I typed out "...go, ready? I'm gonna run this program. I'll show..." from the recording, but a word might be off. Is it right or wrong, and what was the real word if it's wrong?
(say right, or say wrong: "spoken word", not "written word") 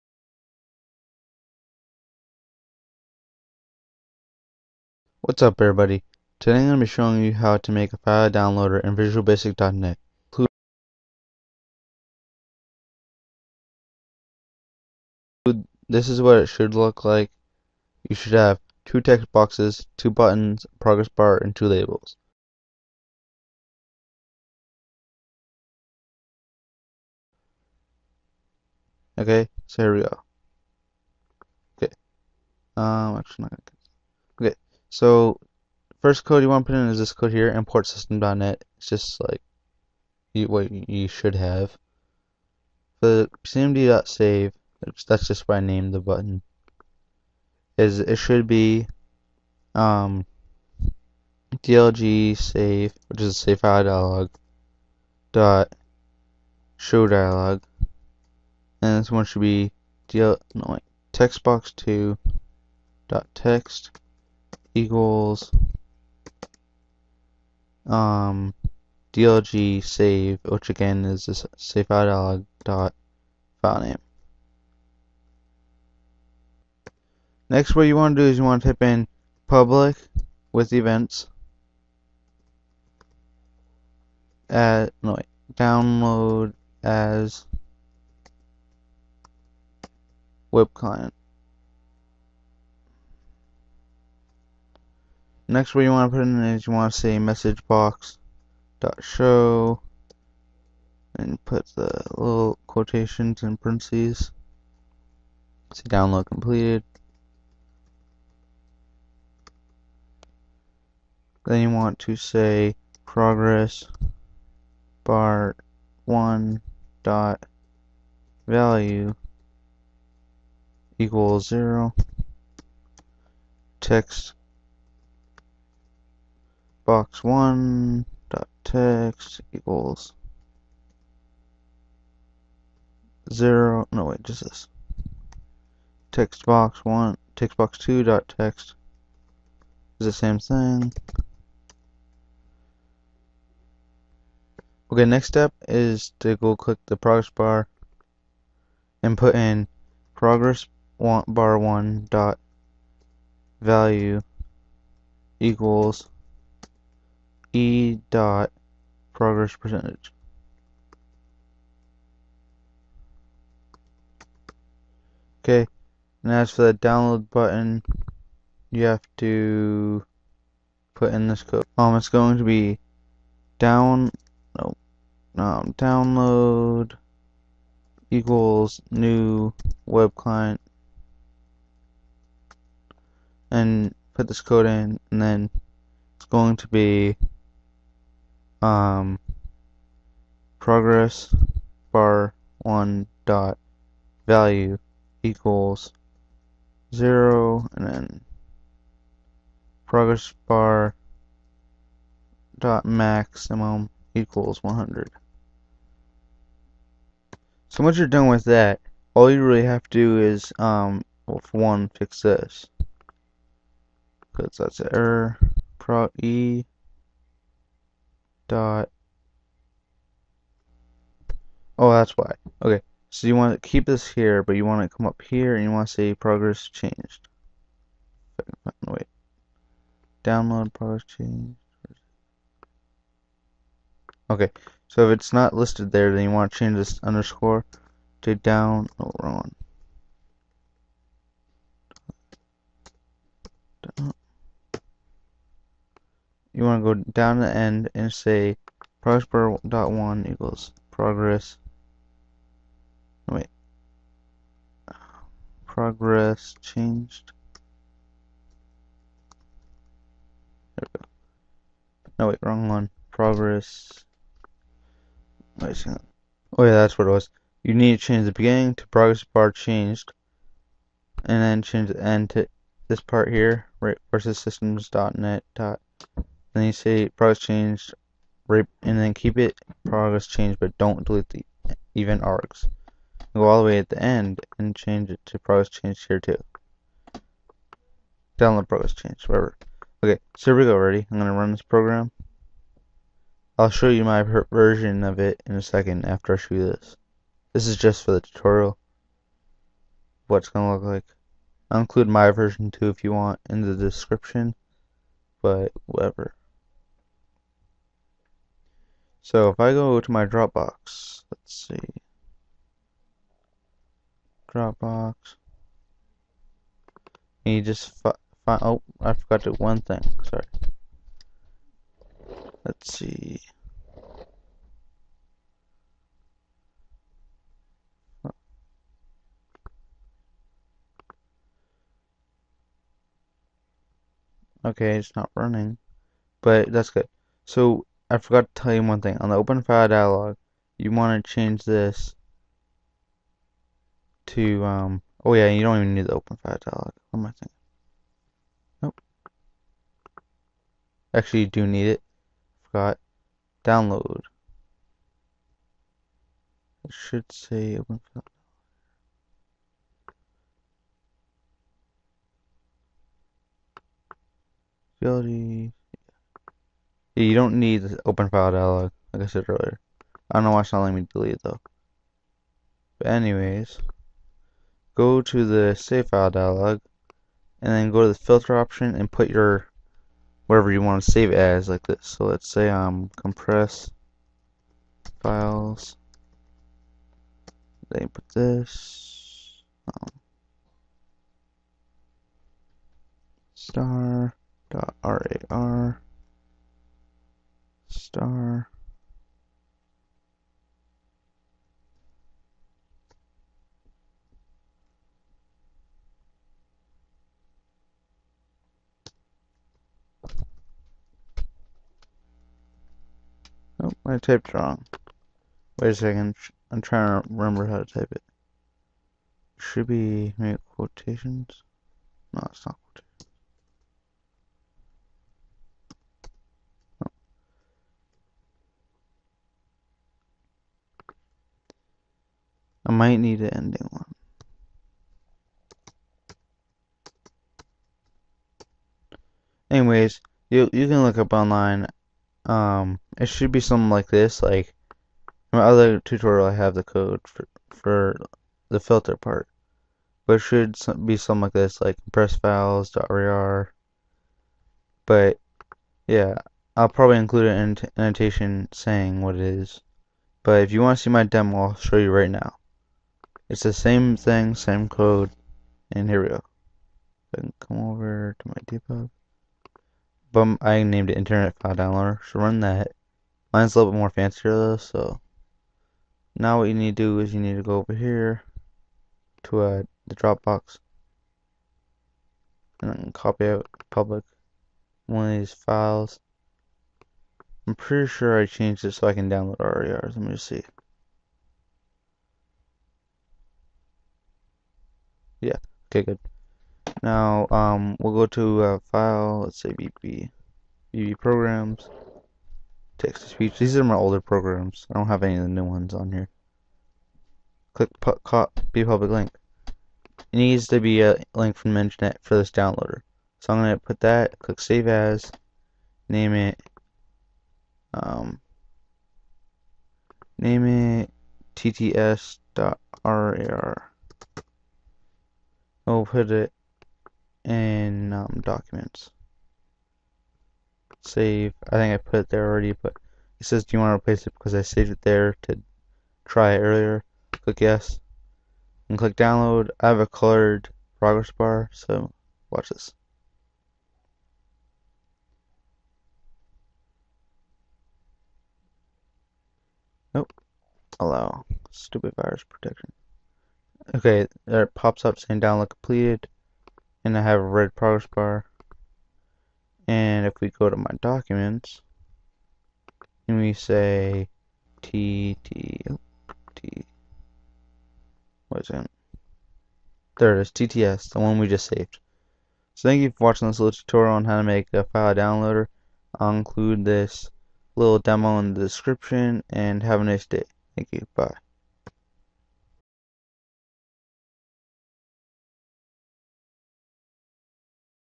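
right.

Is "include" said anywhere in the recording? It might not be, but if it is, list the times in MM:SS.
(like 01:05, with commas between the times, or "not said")
05:01, 07:37, 09:36.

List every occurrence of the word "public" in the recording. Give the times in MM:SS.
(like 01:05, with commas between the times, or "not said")
01:19, 08:03, 08:28.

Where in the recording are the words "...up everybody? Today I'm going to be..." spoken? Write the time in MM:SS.
00:05.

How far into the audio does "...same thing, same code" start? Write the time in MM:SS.
07:43.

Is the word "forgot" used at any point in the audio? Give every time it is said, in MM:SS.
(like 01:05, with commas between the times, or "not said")
05:19, 05:38, 05:52.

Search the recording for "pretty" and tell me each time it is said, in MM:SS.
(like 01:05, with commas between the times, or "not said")
08:07.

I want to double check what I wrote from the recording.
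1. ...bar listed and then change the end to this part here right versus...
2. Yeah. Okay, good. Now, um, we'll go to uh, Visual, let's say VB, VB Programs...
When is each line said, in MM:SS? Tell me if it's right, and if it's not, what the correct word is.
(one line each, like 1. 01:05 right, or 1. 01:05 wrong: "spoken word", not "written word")
1. 04:29 wrong: "changed", not "listed"
2. 08:15 wrong: "File", not "Visual".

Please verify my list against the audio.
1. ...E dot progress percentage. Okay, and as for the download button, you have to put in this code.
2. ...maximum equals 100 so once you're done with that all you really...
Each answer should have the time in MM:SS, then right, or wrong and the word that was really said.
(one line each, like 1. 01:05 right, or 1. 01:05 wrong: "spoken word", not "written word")
1. 02:37 right
2. 03:22 right.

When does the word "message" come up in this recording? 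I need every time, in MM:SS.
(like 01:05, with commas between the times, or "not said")
01:37.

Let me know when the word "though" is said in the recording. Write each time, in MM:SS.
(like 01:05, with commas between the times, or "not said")
06:11, 07:54.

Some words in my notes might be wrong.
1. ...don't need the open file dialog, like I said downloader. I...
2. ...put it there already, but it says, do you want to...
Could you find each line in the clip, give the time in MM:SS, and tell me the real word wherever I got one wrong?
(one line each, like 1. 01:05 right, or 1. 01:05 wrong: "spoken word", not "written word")
1. 06:07 wrong: "earlier", not "downloader"
2. 08:51 right.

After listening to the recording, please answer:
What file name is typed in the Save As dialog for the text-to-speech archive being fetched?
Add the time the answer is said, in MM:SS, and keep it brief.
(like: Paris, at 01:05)
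tts.rar, at 08:41.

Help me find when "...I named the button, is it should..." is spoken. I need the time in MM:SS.
00:45.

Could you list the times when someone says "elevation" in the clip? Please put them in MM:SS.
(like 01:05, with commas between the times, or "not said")
not said.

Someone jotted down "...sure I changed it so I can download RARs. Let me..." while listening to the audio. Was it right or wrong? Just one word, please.
right.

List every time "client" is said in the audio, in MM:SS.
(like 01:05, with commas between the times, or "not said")
01:30, 03:00.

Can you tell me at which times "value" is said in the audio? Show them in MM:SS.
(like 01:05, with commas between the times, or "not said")
01:58, 02:33, 03:14.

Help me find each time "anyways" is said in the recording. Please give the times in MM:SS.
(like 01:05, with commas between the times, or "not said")
06:13, 07:19.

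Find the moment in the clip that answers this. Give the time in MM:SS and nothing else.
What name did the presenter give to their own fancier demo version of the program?
07:51.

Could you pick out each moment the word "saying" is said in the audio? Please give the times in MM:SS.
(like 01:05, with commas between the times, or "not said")
07:38, 09:15.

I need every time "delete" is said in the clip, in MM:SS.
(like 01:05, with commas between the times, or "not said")
04:41, 06:11.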